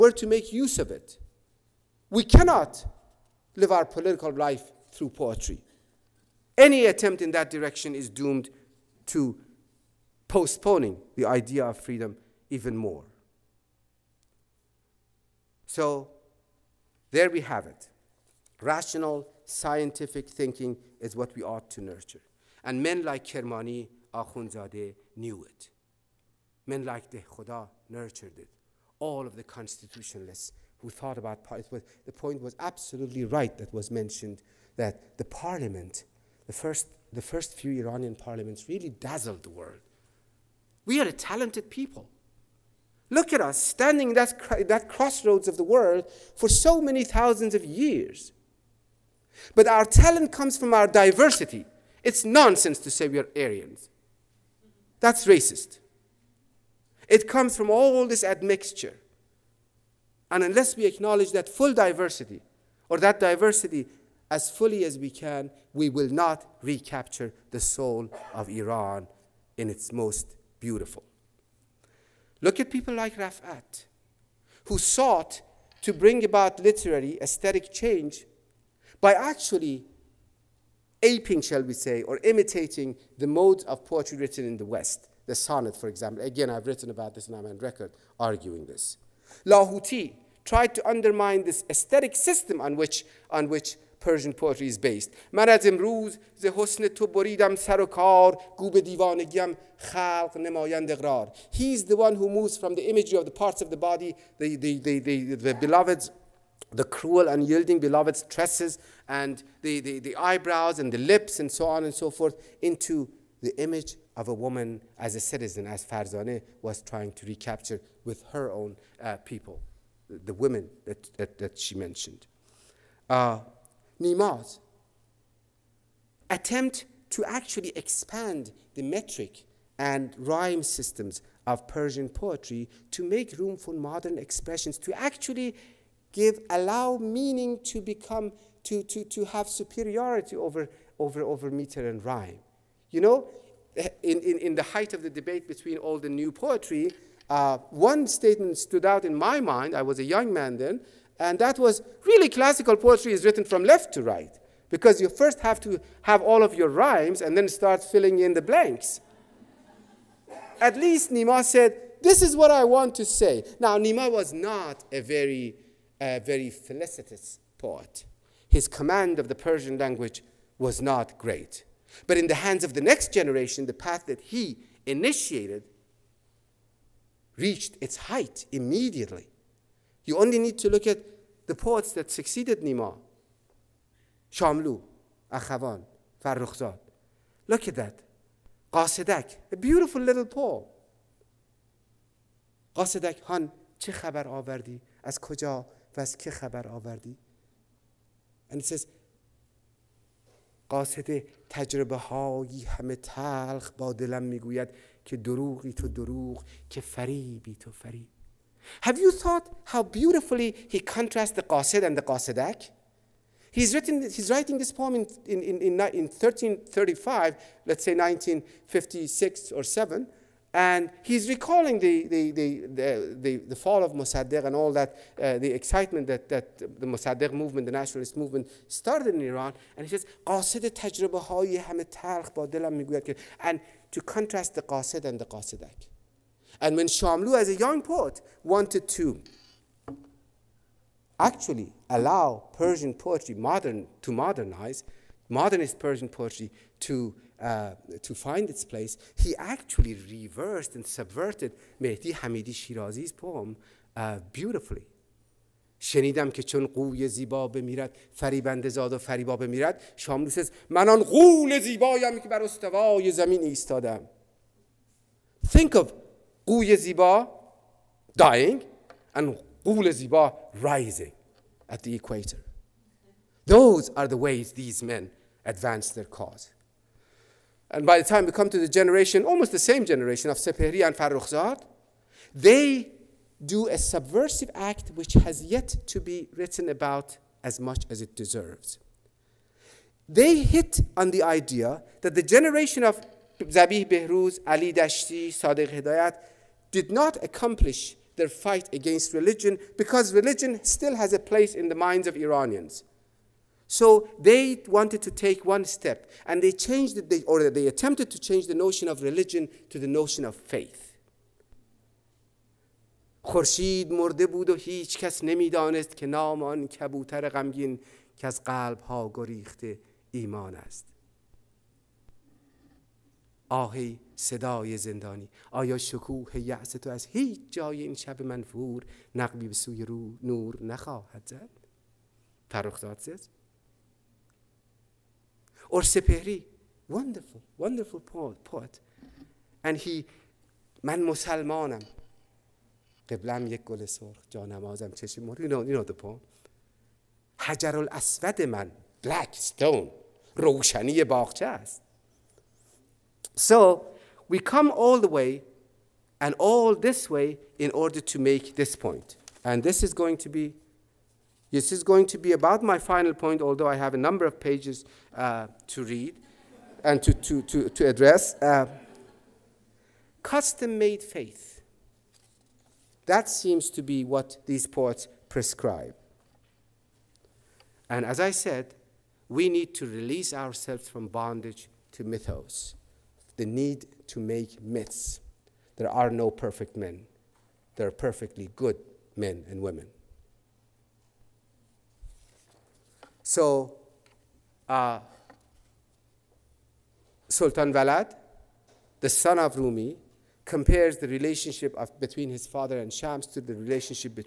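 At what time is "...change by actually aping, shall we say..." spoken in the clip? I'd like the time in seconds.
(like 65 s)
77 s.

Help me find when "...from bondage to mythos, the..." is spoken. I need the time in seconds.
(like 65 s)
380 s.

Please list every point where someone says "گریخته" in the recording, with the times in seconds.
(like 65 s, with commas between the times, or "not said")
319 s.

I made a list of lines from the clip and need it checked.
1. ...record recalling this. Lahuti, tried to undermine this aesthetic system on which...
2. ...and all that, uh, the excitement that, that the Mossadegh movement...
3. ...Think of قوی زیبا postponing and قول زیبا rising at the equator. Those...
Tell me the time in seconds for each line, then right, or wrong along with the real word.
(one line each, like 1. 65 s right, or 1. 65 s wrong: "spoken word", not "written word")
1. 87 s wrong: "arguing", not "recalling"
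2. 224 s right
3. 265 s wrong: "dying", not "postponing".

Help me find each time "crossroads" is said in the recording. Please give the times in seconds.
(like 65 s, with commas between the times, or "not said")
44 s.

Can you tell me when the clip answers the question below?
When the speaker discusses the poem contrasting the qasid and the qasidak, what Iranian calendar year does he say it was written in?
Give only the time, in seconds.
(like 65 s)
216 s.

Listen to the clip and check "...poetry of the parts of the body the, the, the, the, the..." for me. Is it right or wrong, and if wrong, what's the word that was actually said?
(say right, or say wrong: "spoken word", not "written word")
wrong: "imagery", not "poetry".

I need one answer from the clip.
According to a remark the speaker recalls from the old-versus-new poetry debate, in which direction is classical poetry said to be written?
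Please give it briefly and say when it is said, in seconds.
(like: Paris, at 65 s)
Left to right, at 153 s.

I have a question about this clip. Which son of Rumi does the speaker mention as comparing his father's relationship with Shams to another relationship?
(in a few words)
Sultan Valad.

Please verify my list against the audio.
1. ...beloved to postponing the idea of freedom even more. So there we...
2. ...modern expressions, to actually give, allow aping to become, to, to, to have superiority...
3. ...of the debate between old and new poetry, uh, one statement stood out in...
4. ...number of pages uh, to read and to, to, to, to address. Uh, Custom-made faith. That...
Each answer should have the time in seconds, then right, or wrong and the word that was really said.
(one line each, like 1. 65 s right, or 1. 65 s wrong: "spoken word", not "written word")
1. 8 s wrong: "doomed", not "beloved"
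2. 133 s wrong: "meaning", not "aping"
3. 144 s right
4. 363 s right.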